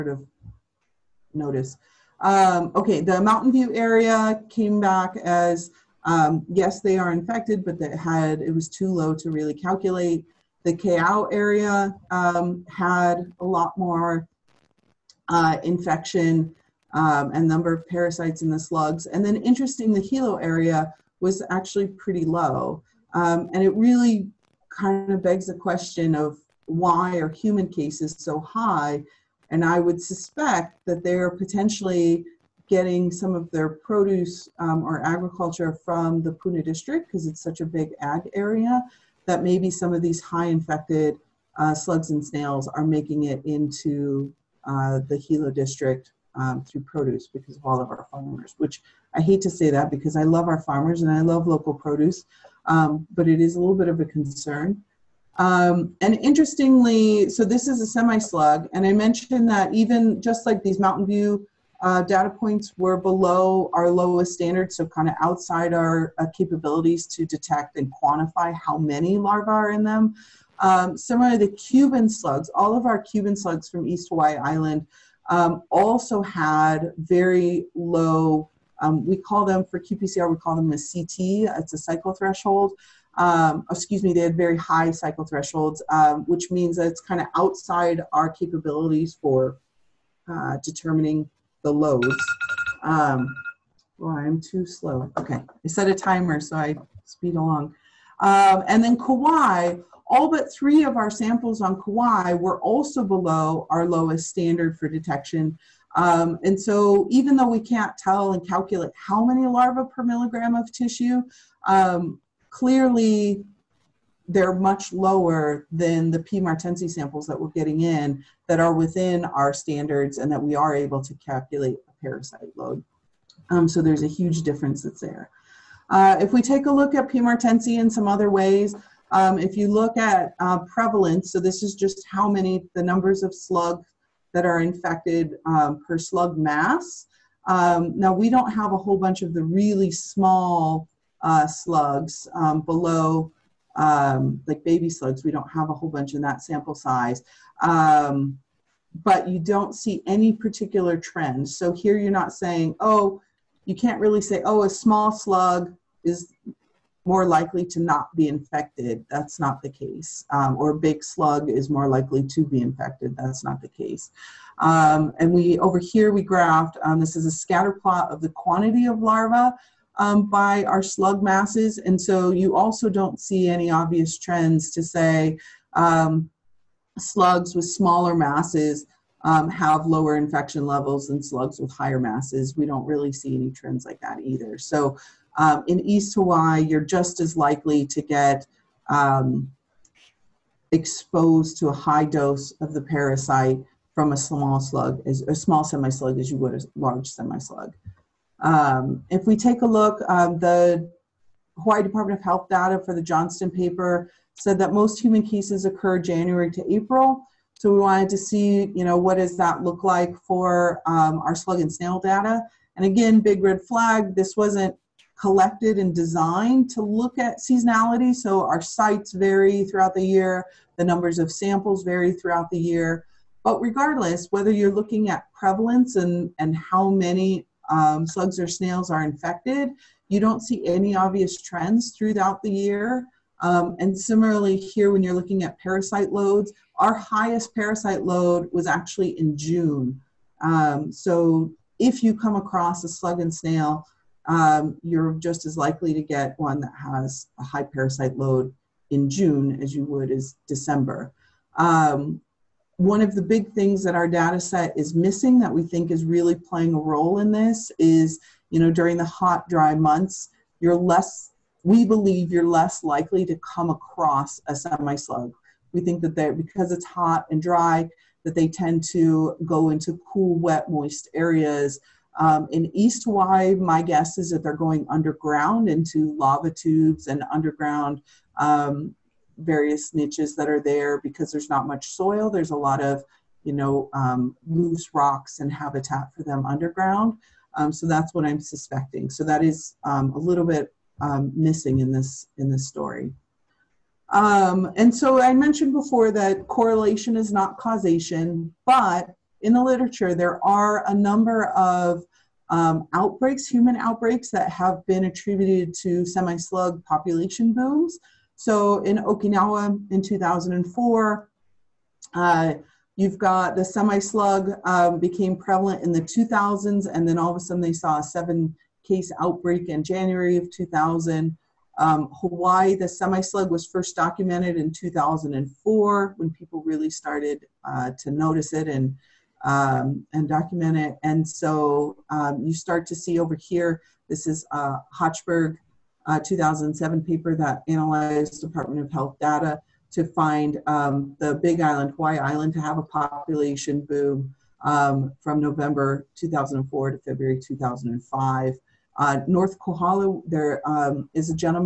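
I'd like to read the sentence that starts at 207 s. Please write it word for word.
So we wanted to see, you know, what does that look like for um, our slug and snail data?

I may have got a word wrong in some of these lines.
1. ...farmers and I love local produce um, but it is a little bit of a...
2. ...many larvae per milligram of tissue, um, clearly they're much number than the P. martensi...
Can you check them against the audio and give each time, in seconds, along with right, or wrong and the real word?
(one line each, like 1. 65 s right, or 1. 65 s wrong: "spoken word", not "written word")
1. 50 s right
2. 109 s wrong: "lower", not "number".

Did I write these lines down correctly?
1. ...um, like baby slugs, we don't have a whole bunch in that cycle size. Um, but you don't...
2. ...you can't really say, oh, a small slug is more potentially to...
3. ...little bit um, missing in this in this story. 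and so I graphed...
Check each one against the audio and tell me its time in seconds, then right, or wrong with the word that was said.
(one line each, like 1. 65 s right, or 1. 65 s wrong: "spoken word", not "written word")
1. 143 s wrong: "sample", not "cycle"
2. 153 s wrong: "likely", not "potentially"
3. 290 s wrong: "mentioned", not "graphed".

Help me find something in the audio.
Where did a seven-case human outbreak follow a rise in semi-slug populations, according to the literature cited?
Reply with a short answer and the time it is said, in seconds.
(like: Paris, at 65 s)
Okinawa, at 308 s.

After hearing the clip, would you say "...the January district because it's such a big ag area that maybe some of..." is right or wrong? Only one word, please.
wrong.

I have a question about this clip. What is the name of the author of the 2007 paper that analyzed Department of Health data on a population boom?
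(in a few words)
Hochberg.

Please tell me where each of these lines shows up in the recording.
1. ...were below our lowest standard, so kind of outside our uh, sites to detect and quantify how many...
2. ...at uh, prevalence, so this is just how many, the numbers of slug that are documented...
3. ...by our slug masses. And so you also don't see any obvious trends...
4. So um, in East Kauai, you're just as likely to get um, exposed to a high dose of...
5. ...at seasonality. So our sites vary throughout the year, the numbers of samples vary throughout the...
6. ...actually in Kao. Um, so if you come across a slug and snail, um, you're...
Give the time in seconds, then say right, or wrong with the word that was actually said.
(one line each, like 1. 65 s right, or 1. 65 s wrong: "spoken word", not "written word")
1. 62 s wrong: "capabilities", not "sites"
2. 129 s wrong: "infected", not "documented"
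3. 170 s right
4. 184 s wrong: "Hawaii", not "Kauai"
5. 217 s right
6. 238 s wrong: "June", not "Kao".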